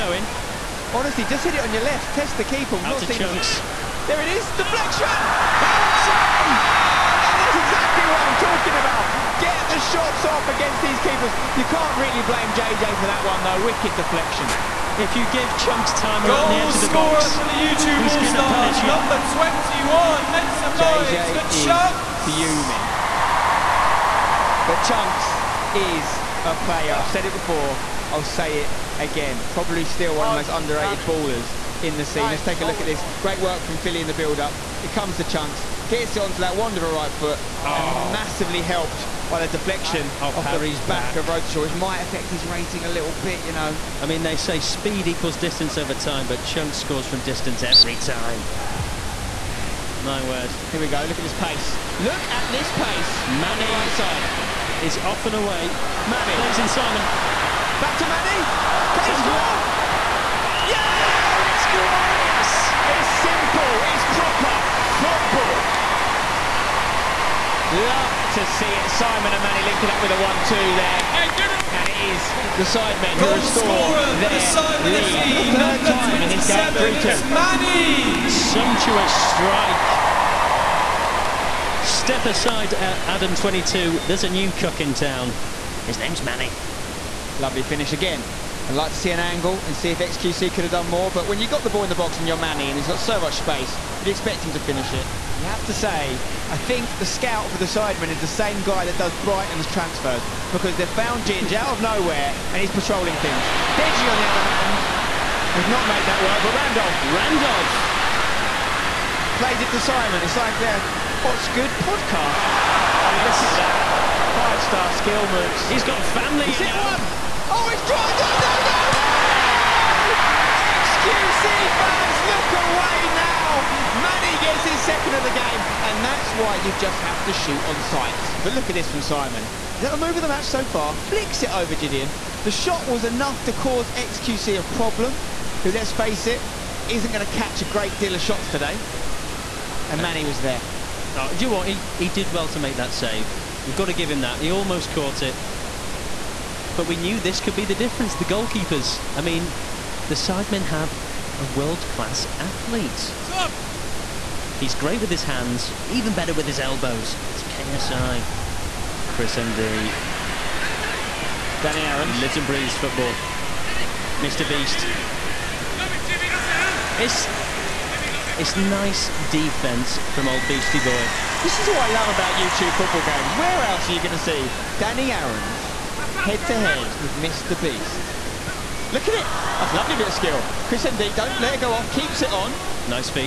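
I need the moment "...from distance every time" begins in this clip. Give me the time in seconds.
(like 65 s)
47 s.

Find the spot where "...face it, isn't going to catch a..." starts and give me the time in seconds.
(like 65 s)
135 s.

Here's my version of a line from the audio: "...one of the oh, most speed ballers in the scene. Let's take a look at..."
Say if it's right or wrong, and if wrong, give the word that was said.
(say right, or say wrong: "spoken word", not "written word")
wrong: "underrated", not "speed".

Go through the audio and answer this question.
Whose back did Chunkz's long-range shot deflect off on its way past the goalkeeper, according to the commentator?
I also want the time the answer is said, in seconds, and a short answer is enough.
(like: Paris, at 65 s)
Harry, at 40 s.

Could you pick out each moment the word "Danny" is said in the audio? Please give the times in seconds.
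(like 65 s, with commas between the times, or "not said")
161 s, 174 s.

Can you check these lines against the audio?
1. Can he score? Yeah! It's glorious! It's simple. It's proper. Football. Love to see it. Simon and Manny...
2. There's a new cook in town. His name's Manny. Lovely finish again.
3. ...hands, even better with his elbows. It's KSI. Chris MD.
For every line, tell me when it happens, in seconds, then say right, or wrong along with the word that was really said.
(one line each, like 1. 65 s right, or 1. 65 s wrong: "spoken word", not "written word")
1. 58 s right
2. 84 s right
3. 155 s right.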